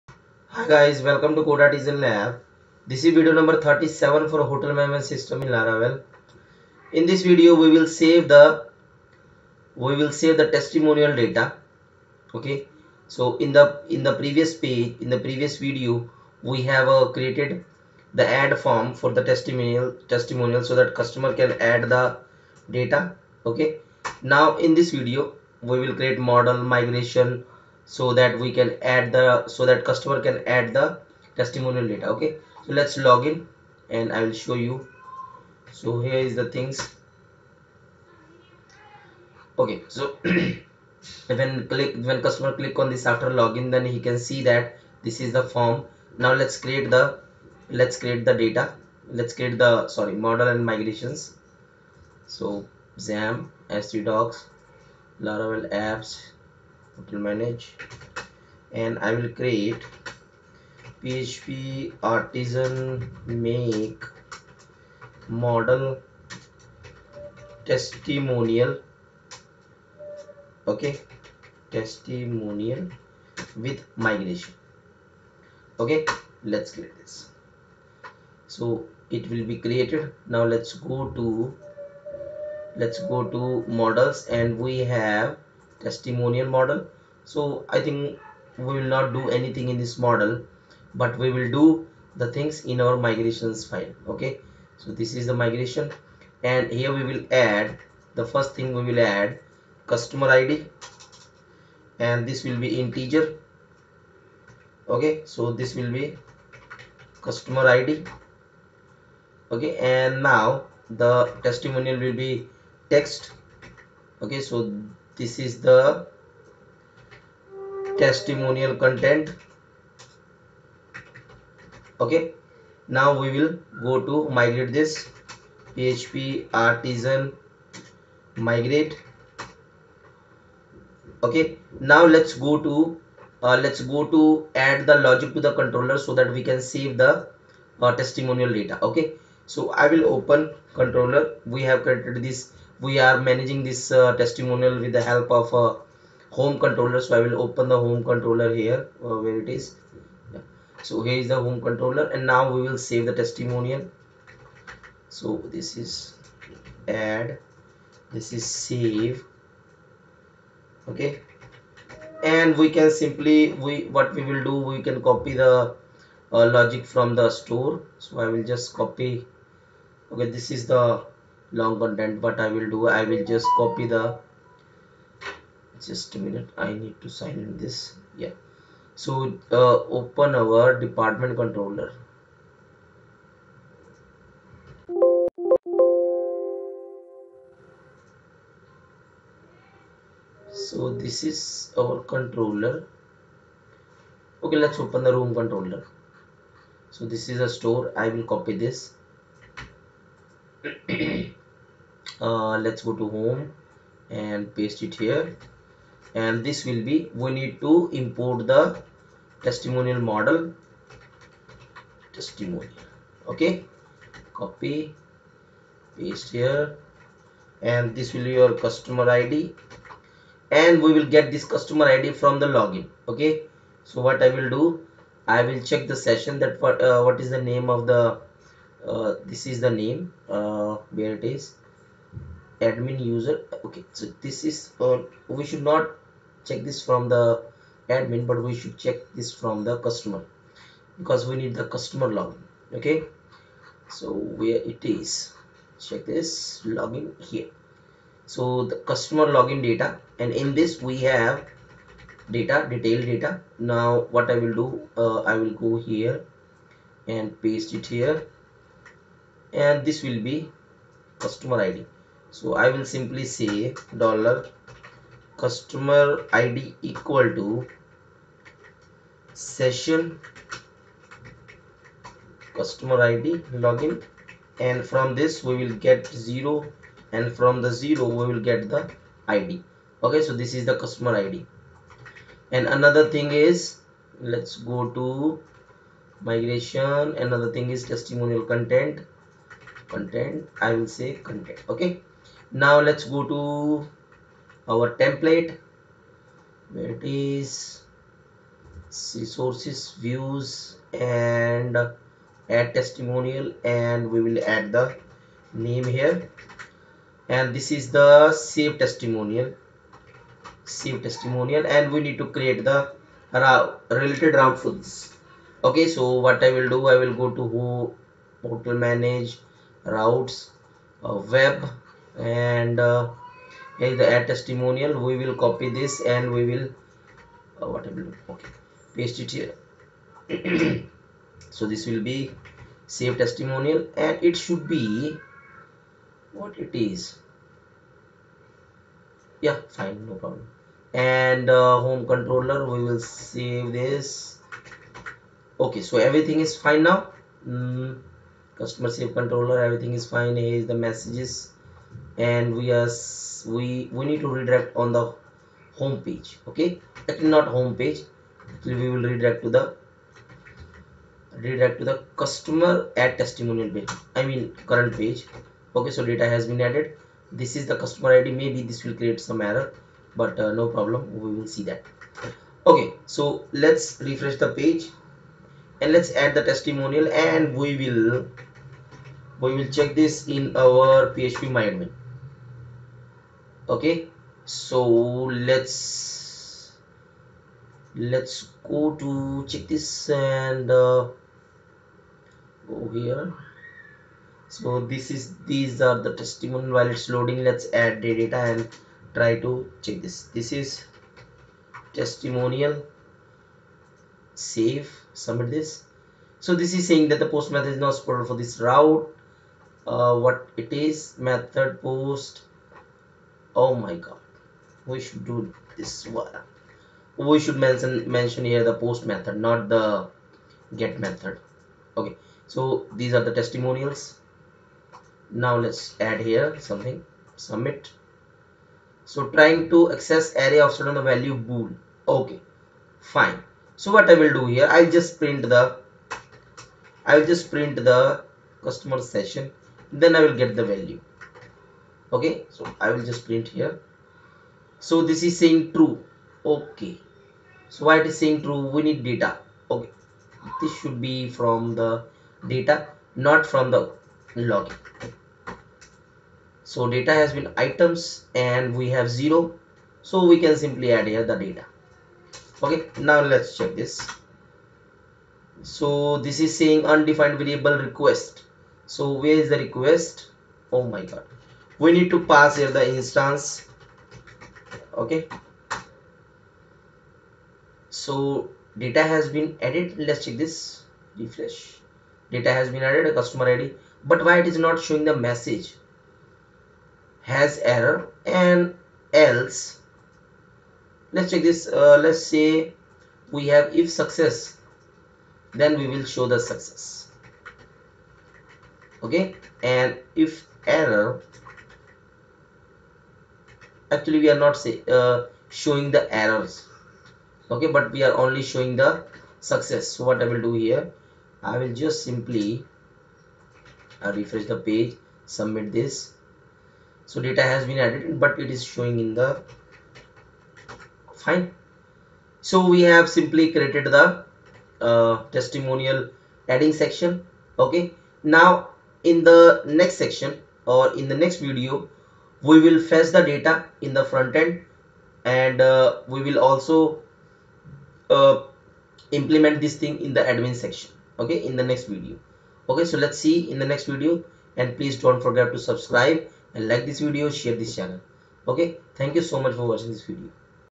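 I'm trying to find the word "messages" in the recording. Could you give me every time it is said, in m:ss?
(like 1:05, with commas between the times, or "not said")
5:50, 8:05.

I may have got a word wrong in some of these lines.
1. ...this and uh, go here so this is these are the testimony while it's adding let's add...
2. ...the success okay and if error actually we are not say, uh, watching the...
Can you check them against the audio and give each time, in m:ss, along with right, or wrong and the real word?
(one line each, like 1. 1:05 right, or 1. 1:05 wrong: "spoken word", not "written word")
1. 6:29 wrong: "loading", not "adding"
2. 8:16 wrong: "showing", not "watching".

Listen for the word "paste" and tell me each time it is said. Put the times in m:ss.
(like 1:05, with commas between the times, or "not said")
3:24, 3:35, 4:17, 5:28.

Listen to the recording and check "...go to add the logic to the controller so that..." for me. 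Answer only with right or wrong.
right.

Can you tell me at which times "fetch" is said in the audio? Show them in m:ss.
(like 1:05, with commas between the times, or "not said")
8:52.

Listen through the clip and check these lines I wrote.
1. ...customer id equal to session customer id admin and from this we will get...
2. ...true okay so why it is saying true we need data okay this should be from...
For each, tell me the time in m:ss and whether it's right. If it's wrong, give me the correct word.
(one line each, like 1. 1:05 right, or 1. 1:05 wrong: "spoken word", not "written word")
1. 4:25 wrong: "login", not "admin"
2. 7:25 right.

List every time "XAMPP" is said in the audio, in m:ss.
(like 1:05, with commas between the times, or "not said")
0:52.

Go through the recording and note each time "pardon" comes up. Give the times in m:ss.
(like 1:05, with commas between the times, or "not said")
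not said.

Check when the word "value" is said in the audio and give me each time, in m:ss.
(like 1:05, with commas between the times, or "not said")
7:11, 7:20.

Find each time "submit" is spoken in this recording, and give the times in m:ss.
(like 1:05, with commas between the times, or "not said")
6:45, 7:07, 8:35.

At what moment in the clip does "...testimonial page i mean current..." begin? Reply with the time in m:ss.
6:03.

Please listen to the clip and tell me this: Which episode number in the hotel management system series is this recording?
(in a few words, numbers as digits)
37.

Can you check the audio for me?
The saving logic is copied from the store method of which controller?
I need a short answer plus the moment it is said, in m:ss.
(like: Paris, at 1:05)
room controller, at 3:15.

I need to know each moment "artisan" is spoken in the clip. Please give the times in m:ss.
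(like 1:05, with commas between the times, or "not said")
0:01, 1:02, 2:06.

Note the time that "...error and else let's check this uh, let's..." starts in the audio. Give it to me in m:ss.
8:07.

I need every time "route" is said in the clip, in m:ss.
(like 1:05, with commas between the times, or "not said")
5:14, 5:19, 6:48.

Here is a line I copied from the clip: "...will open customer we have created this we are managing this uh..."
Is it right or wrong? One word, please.
wrong.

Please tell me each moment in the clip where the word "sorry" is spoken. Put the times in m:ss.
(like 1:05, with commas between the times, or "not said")
0:49.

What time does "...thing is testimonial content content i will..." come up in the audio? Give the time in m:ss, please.
4:47.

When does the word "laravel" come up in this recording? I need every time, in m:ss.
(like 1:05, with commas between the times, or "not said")
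0:05, 0:55.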